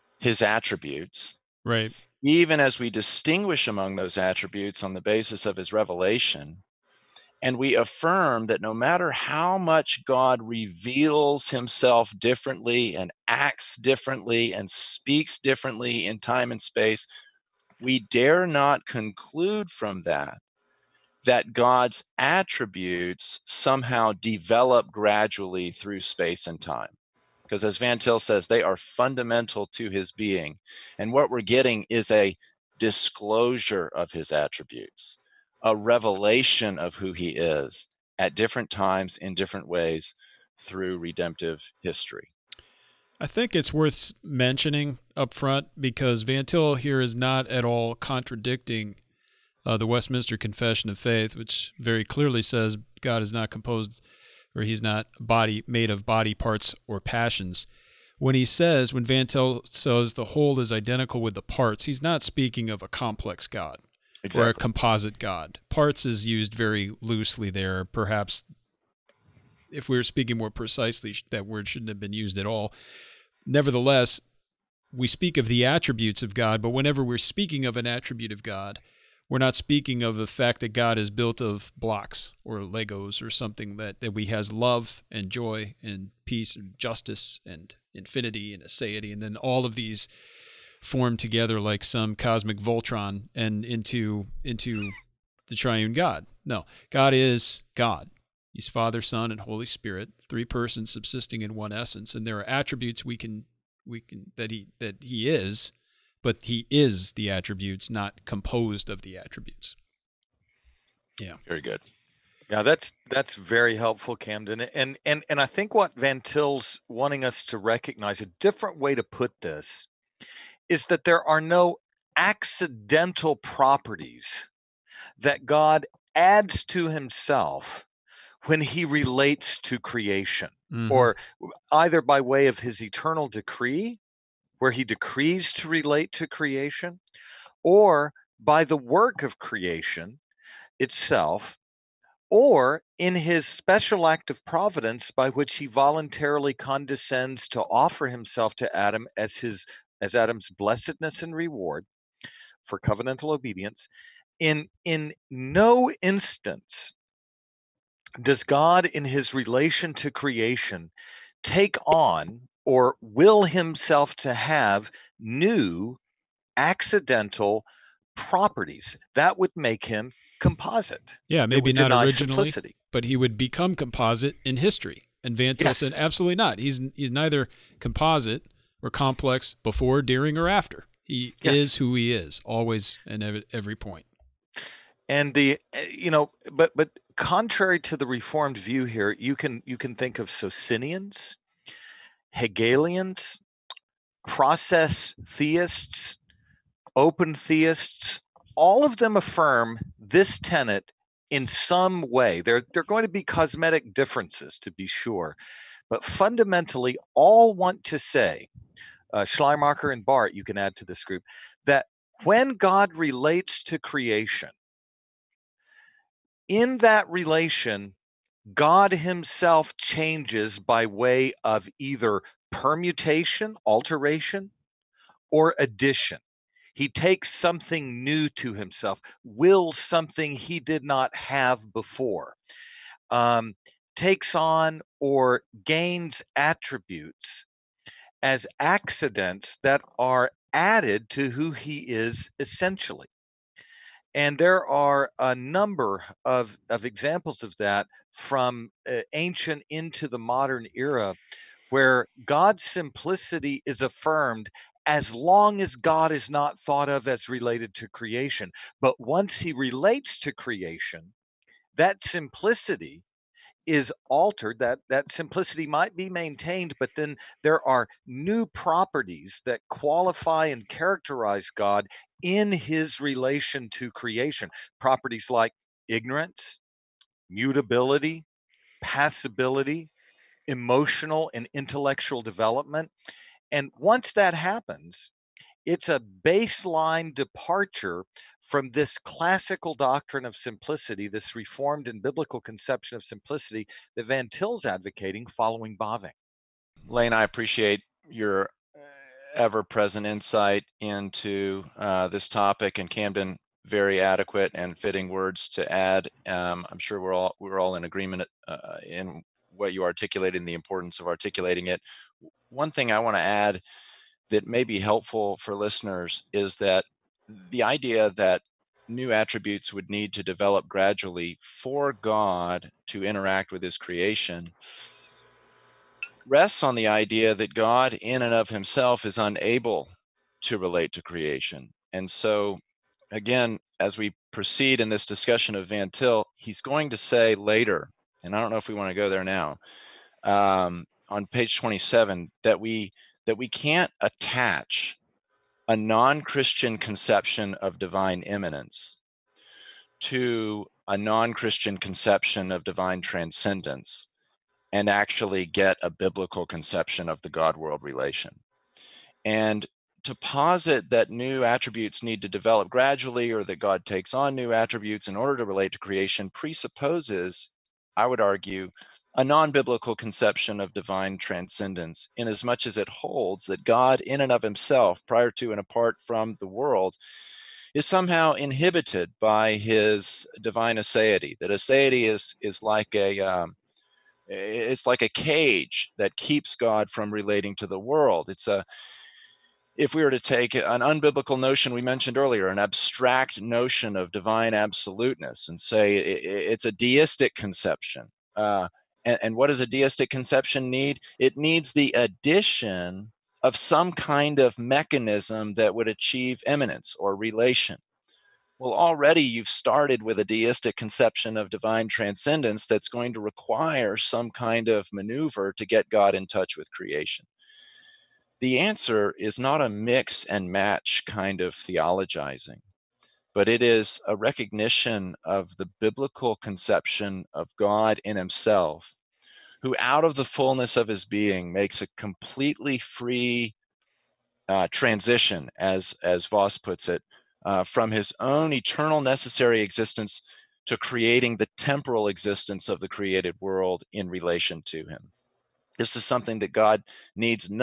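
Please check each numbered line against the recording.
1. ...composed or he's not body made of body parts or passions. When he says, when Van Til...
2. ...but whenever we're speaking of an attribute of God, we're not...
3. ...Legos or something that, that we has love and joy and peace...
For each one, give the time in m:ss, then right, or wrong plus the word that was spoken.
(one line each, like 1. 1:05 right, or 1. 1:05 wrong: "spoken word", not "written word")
1. 0:53 right
2. 1:16 right
3. 1:22 right.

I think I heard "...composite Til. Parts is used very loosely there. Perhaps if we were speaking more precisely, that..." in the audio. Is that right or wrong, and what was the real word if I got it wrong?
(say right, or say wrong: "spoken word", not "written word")
wrong: "God", not "Til".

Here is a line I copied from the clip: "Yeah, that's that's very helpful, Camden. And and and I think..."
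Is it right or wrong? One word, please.
right.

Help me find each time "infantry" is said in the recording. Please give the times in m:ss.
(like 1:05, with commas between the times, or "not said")
not said.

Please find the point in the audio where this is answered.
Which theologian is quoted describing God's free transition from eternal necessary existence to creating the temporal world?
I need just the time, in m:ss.
7:16.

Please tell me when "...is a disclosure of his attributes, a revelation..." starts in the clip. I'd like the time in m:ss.
0:31.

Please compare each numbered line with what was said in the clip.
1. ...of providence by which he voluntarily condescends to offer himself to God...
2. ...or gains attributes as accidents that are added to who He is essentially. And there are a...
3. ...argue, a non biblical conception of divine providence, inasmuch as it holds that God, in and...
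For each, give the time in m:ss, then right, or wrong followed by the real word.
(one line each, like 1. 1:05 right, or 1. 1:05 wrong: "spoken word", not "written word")
1. 2:24 wrong: "Adam", not "God"
2. 3:54 right
3. 6:08 wrong: "transcendence", not "providence".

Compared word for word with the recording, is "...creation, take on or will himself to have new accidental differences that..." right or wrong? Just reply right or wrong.
wrong.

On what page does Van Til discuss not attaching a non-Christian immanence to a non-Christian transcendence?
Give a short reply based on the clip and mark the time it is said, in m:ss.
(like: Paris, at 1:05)
27, at 5:41.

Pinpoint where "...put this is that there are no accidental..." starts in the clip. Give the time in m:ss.
1:59.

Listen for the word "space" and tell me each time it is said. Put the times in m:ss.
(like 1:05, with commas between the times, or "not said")
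0:16, 0:26.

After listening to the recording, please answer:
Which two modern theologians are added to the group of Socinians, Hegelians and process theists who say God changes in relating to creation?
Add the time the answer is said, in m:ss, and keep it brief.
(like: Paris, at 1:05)
Schleiermacher and Barth, at 3:29.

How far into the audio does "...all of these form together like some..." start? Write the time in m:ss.
1:29.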